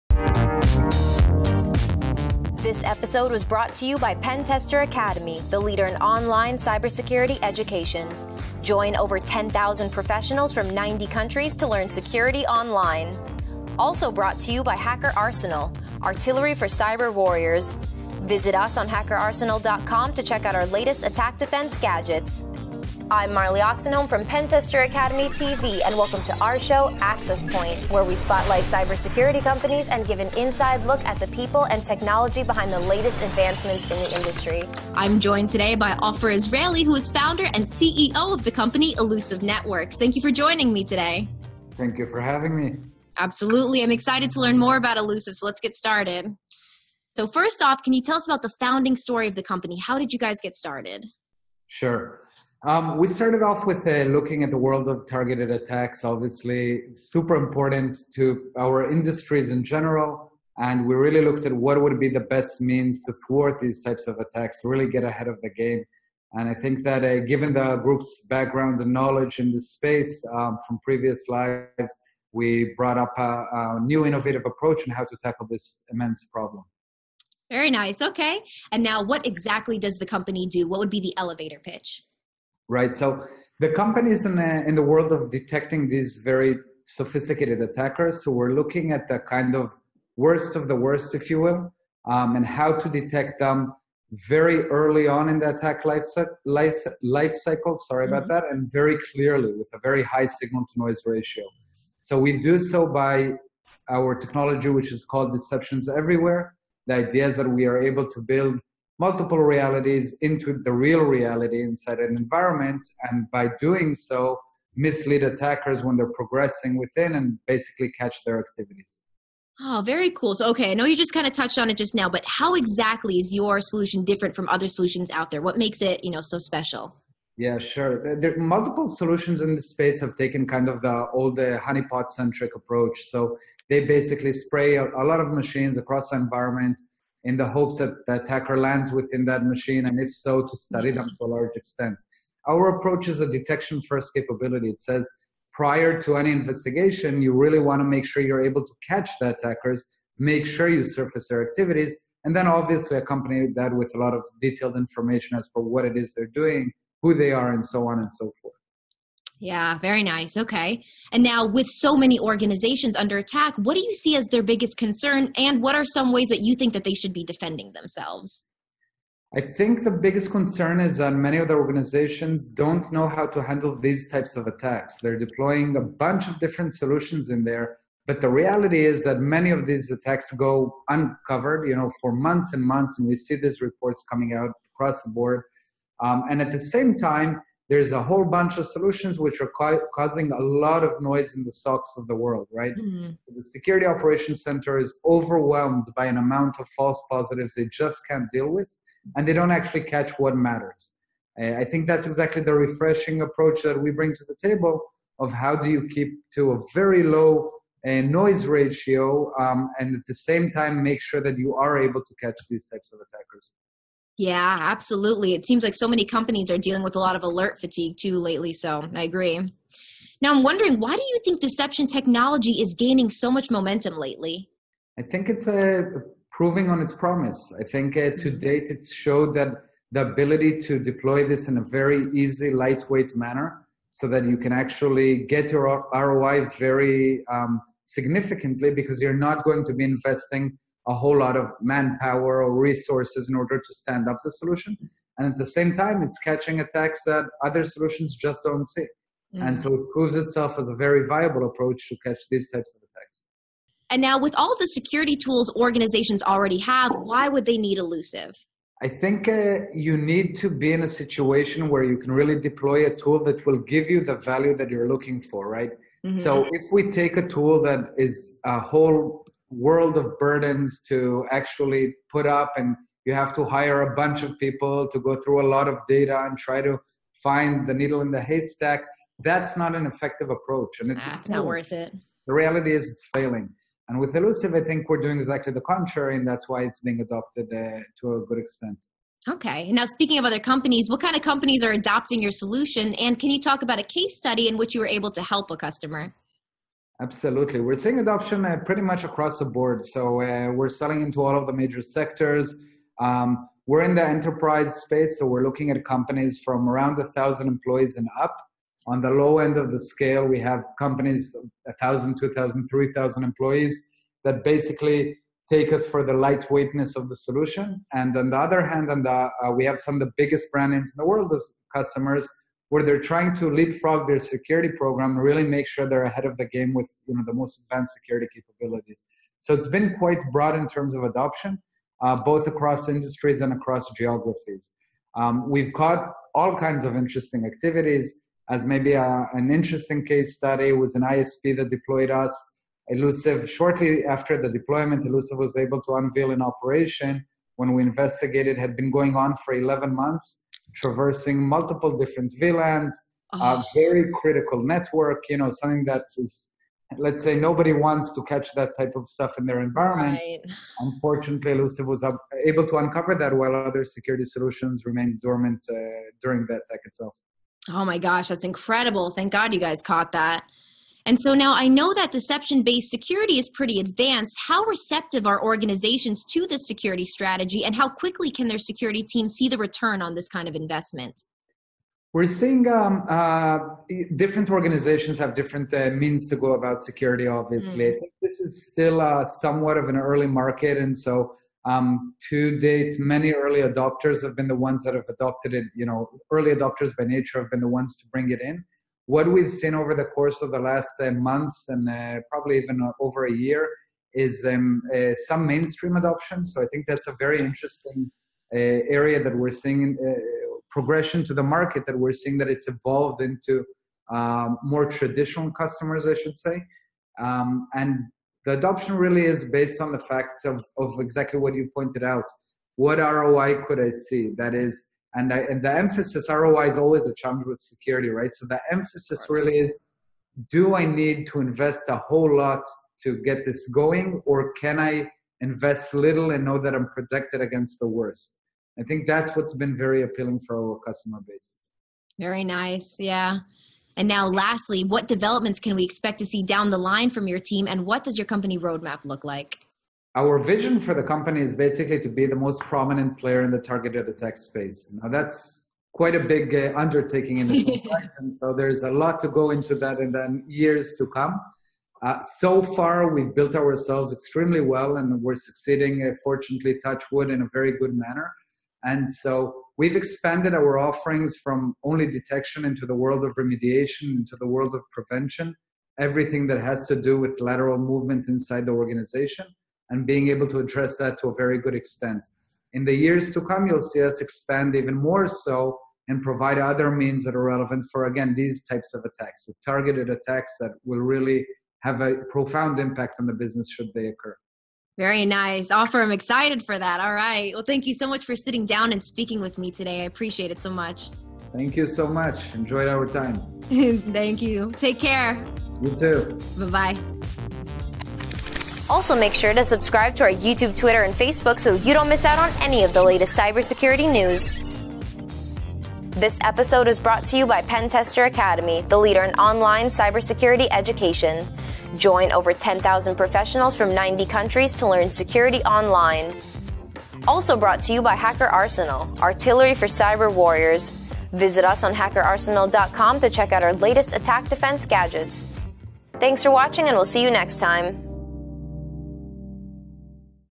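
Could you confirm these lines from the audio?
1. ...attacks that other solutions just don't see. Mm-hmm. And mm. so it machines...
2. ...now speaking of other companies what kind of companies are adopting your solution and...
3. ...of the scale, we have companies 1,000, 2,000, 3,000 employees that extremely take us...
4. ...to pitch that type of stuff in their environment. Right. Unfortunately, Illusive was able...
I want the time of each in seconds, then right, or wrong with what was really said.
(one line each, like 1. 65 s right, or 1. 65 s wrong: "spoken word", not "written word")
1. 246 s wrong: "proves", not "machines"
2. 289 s right
3. 309 s wrong: "basically", not "extremely"
4. 358 s wrong: "catch", not "pitch".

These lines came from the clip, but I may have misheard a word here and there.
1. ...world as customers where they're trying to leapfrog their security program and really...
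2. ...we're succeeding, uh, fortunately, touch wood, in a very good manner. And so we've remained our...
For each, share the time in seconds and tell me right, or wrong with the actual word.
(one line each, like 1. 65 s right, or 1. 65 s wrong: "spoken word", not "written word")
1. 321 s right
2. 465 s wrong: "expanded", not "remained".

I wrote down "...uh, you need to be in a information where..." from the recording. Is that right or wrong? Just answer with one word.
wrong.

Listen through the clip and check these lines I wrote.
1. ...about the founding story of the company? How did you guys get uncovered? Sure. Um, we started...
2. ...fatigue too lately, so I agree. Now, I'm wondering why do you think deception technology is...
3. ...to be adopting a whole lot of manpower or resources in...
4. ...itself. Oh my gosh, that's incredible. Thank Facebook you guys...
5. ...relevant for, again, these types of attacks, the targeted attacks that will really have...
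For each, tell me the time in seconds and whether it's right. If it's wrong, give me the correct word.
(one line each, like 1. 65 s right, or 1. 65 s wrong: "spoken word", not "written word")
1. 48 s wrong: "started", not "uncovered"
2. 217 s right
3. 239 s wrong: "investing", not "adopting"
4. 366 s wrong: "God", not "Facebook"
5. 487 s right.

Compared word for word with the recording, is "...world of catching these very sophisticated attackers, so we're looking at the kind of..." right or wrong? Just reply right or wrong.
wrong.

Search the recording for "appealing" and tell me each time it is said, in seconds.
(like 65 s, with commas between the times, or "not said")
440 s.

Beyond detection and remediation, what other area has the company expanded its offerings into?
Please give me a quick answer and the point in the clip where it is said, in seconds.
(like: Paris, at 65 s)
prevention, at 474 s.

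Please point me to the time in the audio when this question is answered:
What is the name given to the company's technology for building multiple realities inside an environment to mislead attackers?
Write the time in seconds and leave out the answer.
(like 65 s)
105 s.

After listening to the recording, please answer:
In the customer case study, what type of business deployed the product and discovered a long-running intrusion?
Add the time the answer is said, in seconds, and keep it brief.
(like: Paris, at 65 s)
ISP, at 341 s.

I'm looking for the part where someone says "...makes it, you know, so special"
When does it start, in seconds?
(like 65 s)
125 s.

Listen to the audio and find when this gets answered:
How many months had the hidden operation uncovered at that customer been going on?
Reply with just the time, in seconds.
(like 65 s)
349 s.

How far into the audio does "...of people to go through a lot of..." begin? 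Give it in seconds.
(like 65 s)
274 s.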